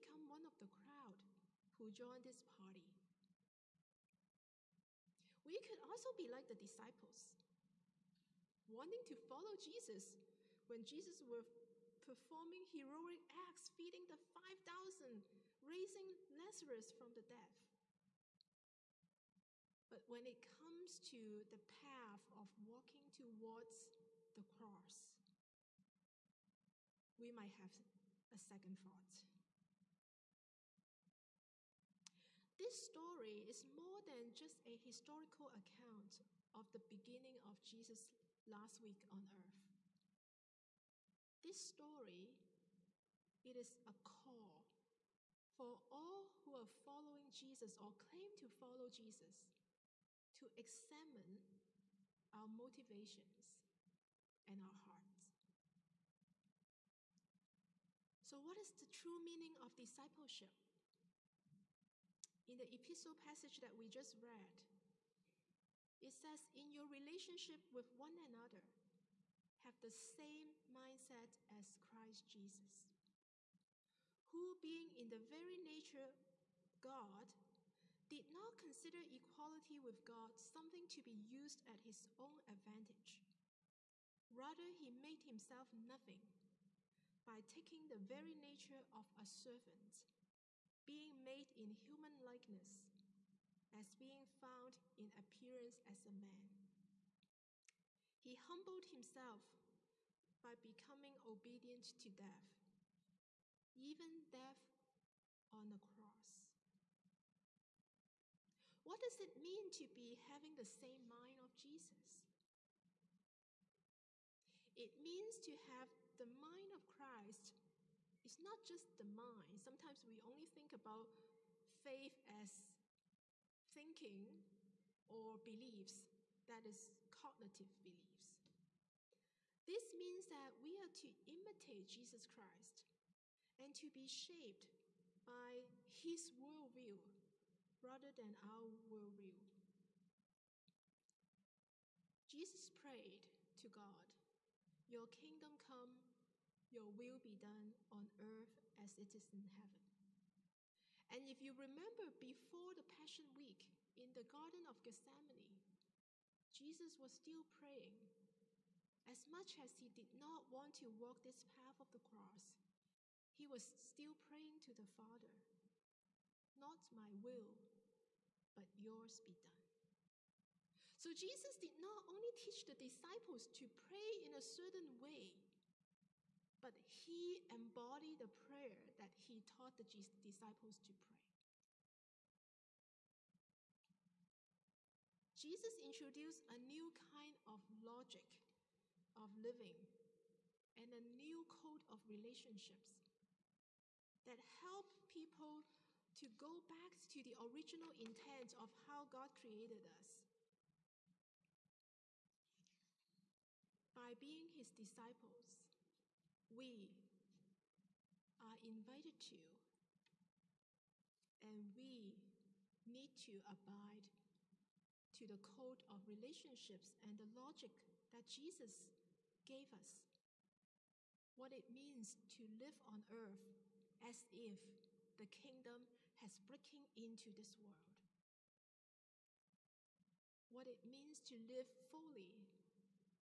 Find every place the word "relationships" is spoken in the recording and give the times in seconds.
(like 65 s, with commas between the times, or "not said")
66 s, 192 s, 216 s.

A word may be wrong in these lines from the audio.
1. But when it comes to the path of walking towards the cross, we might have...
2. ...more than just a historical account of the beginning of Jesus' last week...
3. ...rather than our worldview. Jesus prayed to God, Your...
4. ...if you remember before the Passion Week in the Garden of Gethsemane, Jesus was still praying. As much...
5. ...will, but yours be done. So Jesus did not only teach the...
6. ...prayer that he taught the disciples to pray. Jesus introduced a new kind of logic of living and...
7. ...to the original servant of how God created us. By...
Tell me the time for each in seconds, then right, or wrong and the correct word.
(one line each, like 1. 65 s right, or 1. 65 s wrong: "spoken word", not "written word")
1. 19 s right
2. 33 s right
3. 137 s right
4. 151 s right
5. 167 s right
6. 178 s right
7. 197 s wrong: "intent", not "servant".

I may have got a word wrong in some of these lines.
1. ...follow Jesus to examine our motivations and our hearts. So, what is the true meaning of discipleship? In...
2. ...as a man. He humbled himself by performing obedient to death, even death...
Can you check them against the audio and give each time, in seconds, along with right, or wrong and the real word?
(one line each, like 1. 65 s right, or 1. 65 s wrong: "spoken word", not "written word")
1. 48 s right
2. 95 s wrong: "becoming", not "performing".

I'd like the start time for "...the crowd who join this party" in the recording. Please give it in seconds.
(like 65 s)
0 s.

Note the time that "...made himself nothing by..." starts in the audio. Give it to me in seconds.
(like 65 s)
84 s.